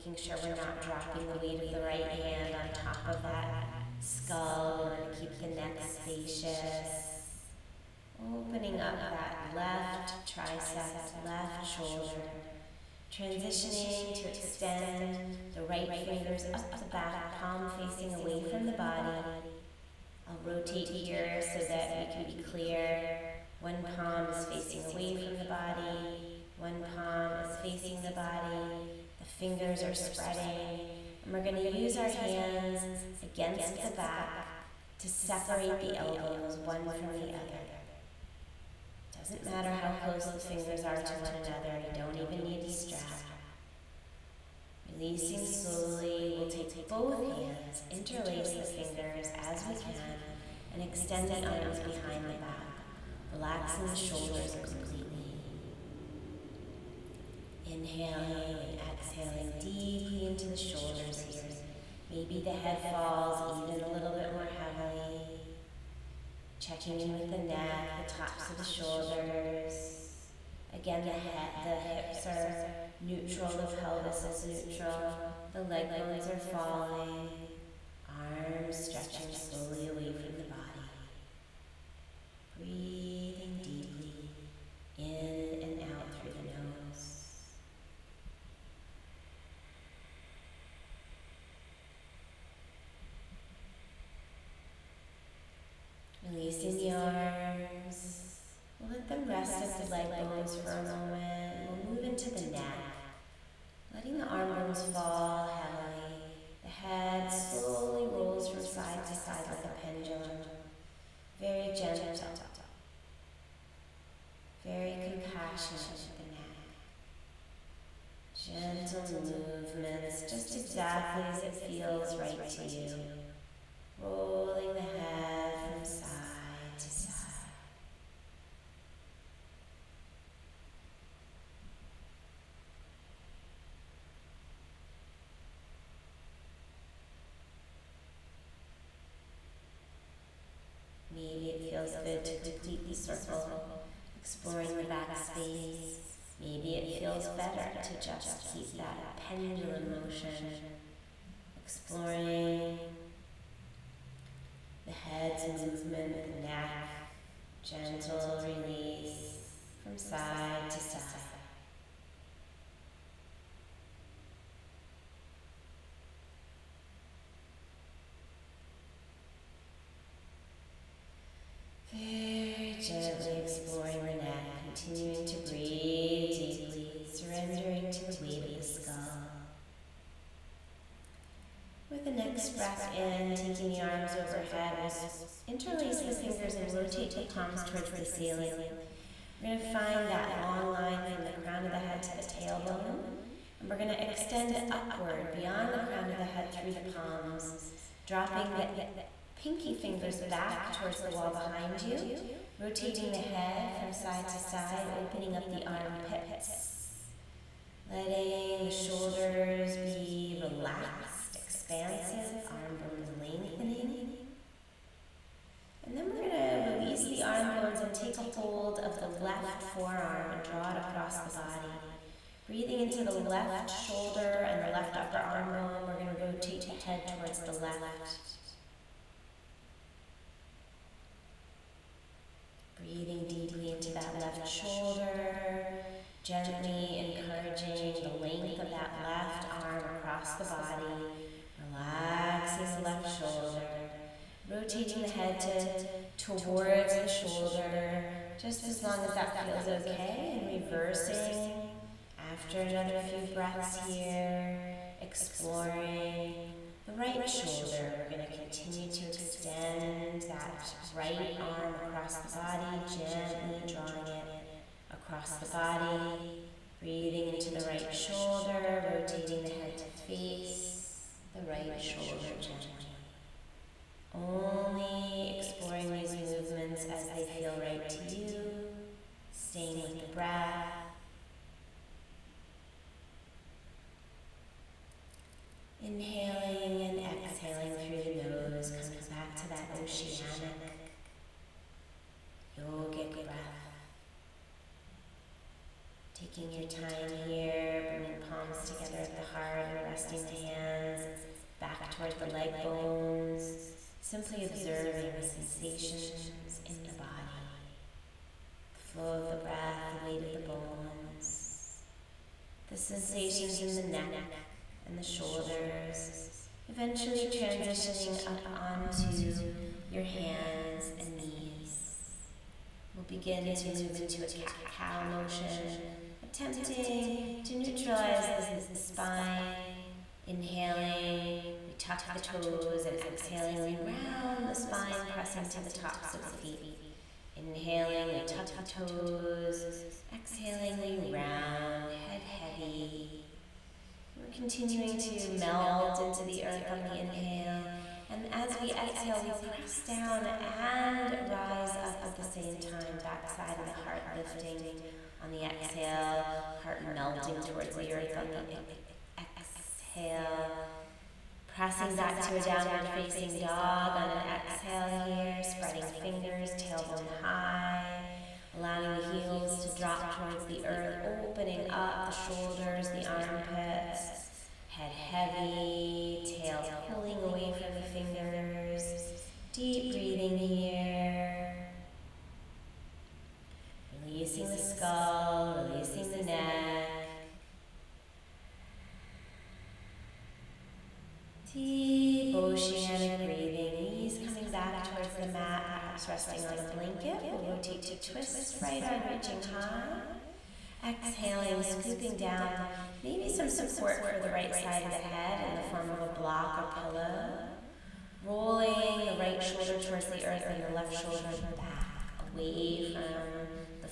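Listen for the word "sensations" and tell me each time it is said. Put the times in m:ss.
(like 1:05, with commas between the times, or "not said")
5:05, 5:12.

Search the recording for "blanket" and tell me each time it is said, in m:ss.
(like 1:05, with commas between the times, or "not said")
6:36.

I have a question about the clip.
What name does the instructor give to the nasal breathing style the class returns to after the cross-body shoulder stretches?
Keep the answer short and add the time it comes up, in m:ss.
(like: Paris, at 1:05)
oceanic yogic breath, at 4:49.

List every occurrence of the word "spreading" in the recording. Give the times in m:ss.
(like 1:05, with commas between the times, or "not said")
0:29, 6:05.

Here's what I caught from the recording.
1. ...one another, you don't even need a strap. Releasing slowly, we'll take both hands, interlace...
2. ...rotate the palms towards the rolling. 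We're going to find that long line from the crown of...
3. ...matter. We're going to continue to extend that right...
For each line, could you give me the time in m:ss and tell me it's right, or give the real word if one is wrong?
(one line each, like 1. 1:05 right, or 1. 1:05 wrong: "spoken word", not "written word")
1. 0:41 right
2. 3:06 wrong: "ceiling", not "rolling"
3. 4:17 wrong: "shoulder", not "matter".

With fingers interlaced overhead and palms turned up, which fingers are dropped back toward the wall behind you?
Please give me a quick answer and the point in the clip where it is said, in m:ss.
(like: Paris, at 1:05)
pinky fingers, at 3:19.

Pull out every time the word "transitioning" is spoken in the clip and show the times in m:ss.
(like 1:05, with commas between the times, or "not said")
0:13, 5:17.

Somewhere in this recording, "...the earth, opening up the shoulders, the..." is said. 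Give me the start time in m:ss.
6:10.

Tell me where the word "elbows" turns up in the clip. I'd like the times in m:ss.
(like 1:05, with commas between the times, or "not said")
0:35.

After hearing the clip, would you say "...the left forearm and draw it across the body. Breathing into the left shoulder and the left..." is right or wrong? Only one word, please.
right.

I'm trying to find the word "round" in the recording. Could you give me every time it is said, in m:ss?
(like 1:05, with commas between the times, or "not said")
5:33, 5:41.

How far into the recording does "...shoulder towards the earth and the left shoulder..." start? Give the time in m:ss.
6:49.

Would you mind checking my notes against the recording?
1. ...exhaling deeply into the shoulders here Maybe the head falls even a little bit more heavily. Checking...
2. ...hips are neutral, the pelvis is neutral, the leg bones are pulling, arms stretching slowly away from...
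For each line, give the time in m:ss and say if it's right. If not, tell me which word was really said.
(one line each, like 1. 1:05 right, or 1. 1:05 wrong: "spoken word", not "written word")
1. 0:58 right
2. 1:11 wrong: "falling", not "pulling".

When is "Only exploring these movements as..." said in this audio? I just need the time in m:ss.
4:34.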